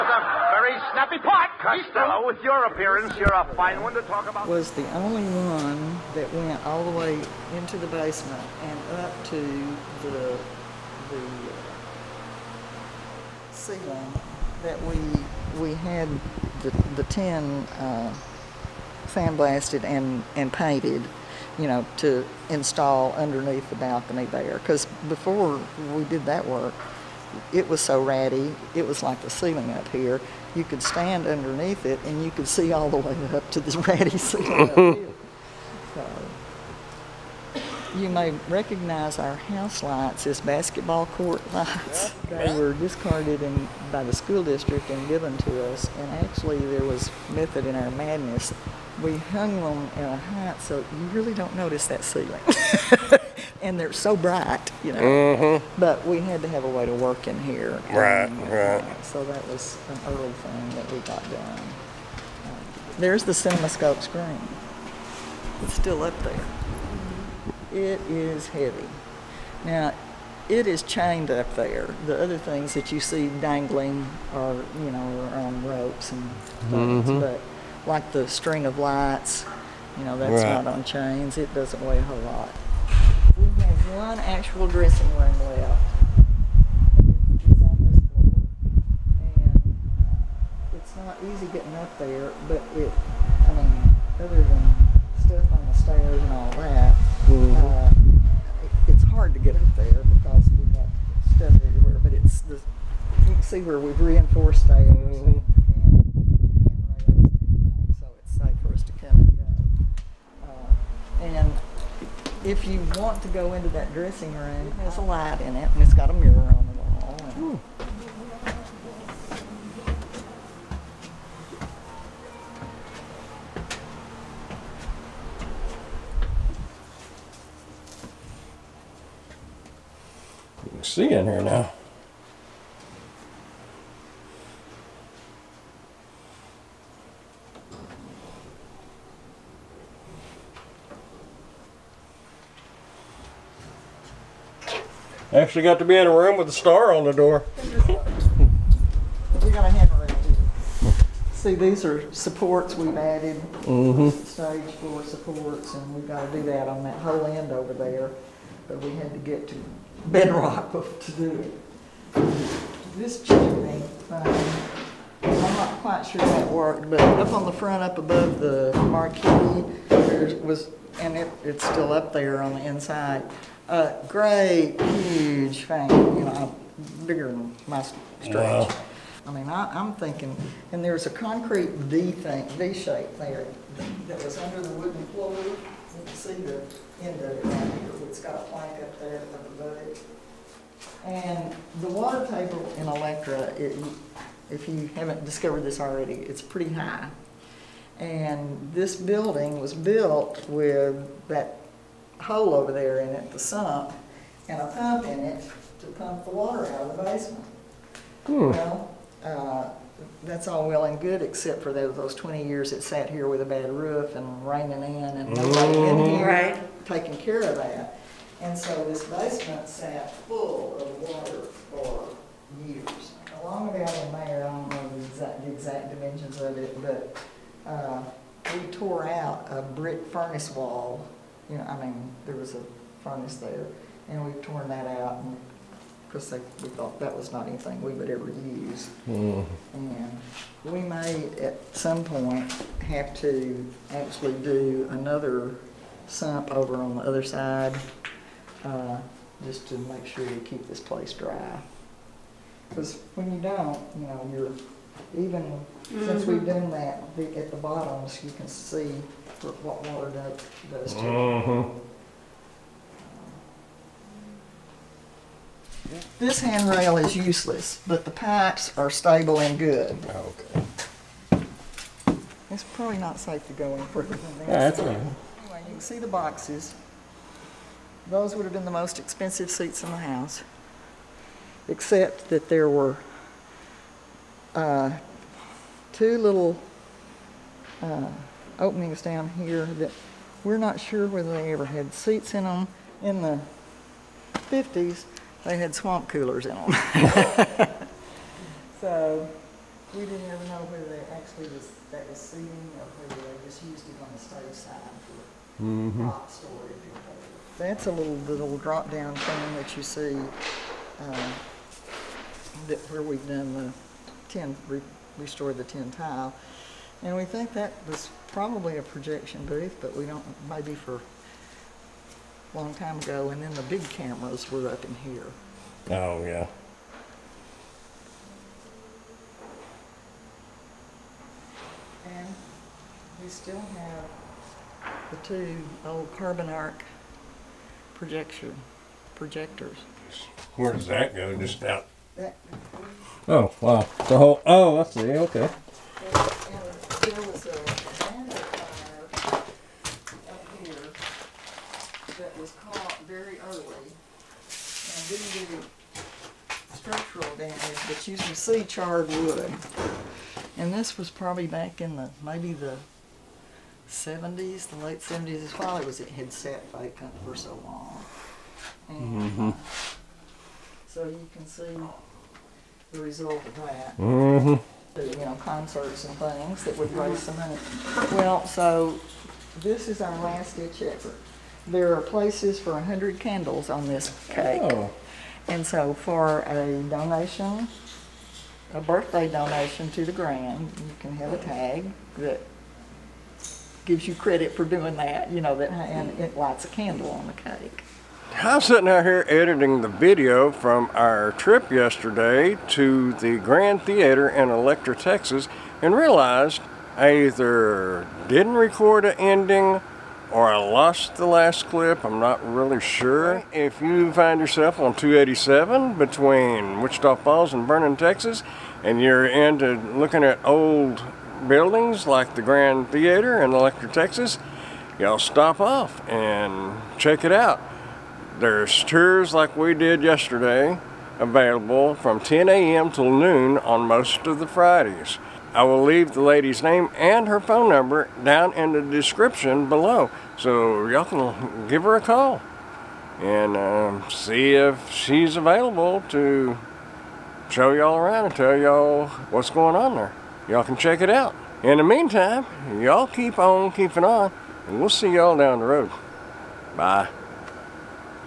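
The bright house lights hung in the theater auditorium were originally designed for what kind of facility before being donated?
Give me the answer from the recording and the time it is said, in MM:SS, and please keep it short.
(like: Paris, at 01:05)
Basketball court, at 00:40.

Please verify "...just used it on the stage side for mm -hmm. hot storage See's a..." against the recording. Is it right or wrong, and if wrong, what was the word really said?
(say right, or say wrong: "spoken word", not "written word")
wrong: "That", not "See".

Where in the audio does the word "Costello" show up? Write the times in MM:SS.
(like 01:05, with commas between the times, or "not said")
00:01.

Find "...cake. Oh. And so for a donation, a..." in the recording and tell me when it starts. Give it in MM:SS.
06:24.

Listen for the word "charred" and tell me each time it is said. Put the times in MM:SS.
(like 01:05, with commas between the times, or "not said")
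05:58.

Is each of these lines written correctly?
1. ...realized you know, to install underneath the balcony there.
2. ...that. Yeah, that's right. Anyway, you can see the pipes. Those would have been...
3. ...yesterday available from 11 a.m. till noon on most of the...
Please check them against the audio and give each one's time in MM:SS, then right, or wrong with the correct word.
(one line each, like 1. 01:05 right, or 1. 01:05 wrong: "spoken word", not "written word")
1. 00:20 wrong: "painted", not "realized"
2. 04:34 wrong: "boxes", not "pipes"
3. 07:10 wrong: "10", not "11".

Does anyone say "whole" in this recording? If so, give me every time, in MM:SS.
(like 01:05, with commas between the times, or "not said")
01:22, 02:37, 05:44.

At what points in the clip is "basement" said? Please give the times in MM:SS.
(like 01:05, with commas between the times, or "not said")
00:07, 03:27, 03:39.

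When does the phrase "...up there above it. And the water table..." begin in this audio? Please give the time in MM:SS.
03:08.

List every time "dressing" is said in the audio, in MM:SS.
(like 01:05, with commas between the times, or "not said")
01:24, 01:53.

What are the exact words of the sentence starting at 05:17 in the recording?
And we think that was probably a projection booth, but we don't, maybe for a long time ago.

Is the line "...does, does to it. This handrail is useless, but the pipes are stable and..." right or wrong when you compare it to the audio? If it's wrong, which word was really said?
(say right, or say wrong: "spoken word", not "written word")
right.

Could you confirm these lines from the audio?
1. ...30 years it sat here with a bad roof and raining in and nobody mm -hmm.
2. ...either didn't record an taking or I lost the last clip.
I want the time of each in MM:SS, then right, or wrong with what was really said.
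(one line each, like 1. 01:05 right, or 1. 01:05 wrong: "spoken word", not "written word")
1. 03:32 wrong: "20", not "30"
2. 06:47 wrong: "ending", not "taking".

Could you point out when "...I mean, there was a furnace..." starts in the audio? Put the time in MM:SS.
03:51.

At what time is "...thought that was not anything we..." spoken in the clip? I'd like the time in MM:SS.
03:56.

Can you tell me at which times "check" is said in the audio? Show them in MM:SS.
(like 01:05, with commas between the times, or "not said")
07:06, 07:30.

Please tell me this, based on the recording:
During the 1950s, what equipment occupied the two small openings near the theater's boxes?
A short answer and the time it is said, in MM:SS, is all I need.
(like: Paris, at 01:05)
Swamp coolers, at 04:55.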